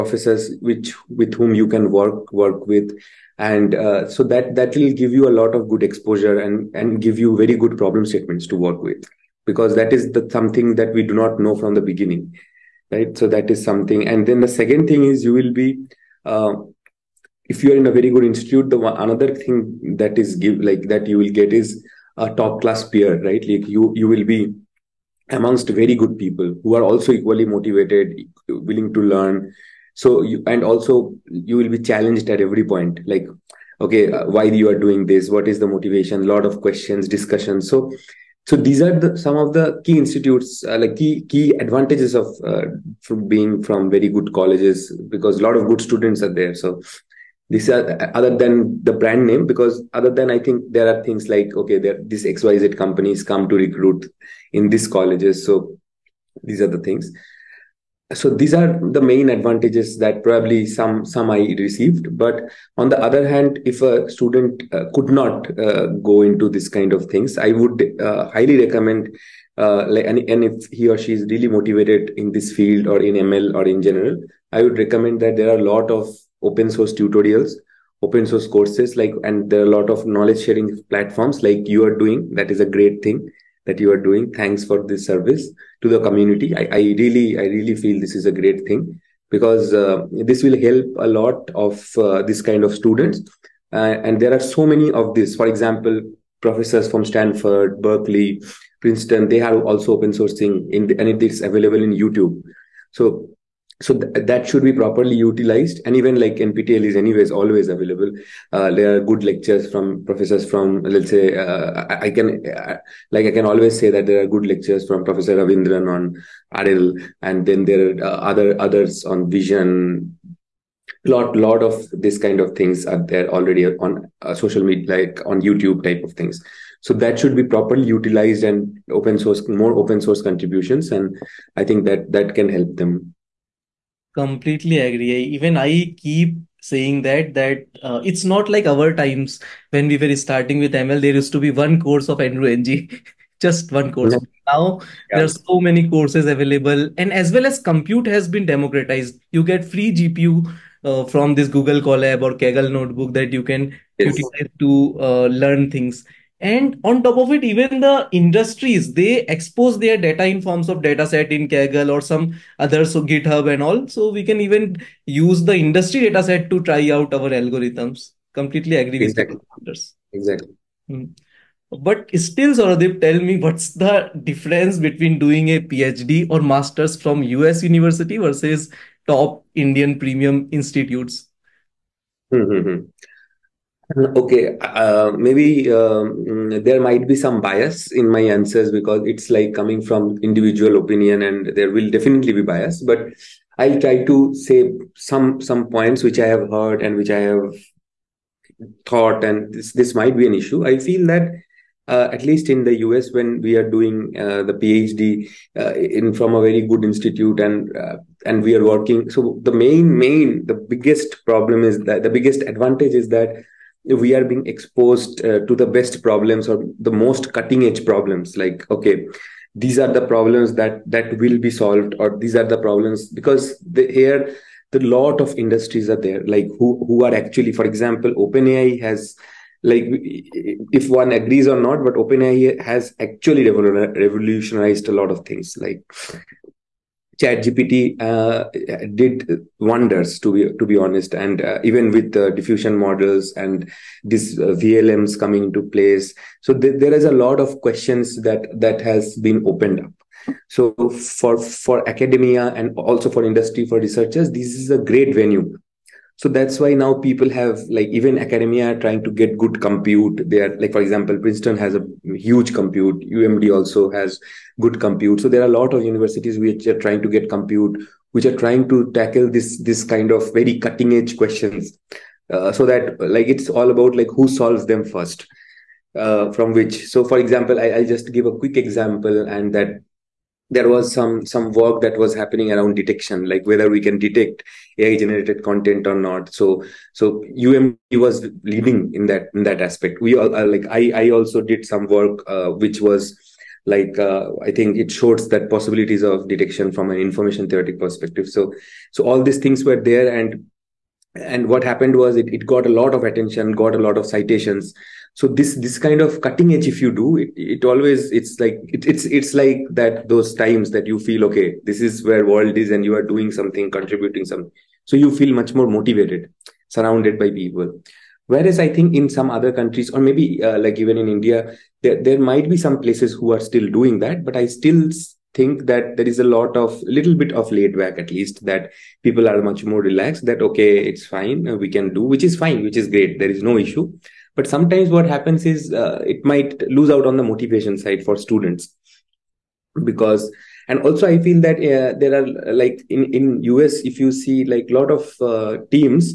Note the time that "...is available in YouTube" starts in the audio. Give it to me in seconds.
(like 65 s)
101 s.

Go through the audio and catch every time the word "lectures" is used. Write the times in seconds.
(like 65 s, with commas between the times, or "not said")
109 s, 114 s.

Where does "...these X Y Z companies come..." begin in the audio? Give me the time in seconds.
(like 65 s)
52 s.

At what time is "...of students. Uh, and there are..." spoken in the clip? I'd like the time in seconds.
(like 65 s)
92 s.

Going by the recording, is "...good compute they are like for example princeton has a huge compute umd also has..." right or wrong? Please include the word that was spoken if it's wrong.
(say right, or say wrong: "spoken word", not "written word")
right.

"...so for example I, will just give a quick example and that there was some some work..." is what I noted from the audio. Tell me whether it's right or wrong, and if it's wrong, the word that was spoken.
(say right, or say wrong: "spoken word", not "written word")
right.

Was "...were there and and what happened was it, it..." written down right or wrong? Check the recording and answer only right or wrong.
right.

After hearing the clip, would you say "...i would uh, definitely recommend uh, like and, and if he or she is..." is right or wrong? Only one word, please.
wrong.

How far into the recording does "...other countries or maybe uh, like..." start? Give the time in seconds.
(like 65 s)
319 s.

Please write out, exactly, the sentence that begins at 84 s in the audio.
Thanks for this service to the community.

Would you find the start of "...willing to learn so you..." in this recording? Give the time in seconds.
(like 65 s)
28 s.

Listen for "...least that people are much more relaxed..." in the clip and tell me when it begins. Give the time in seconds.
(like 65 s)
328 s.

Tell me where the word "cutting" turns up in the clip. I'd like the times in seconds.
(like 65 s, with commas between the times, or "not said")
217 s, 270 s, 306 s.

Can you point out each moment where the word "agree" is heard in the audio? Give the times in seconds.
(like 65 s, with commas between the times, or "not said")
134 s, 168 s, 231 s.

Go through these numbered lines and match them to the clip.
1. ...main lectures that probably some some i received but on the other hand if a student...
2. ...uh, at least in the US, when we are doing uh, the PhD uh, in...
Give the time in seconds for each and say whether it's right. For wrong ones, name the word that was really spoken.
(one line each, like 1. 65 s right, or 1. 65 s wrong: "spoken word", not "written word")
1. 59 s wrong: "advantages", not "lectures"
2. 201 s right.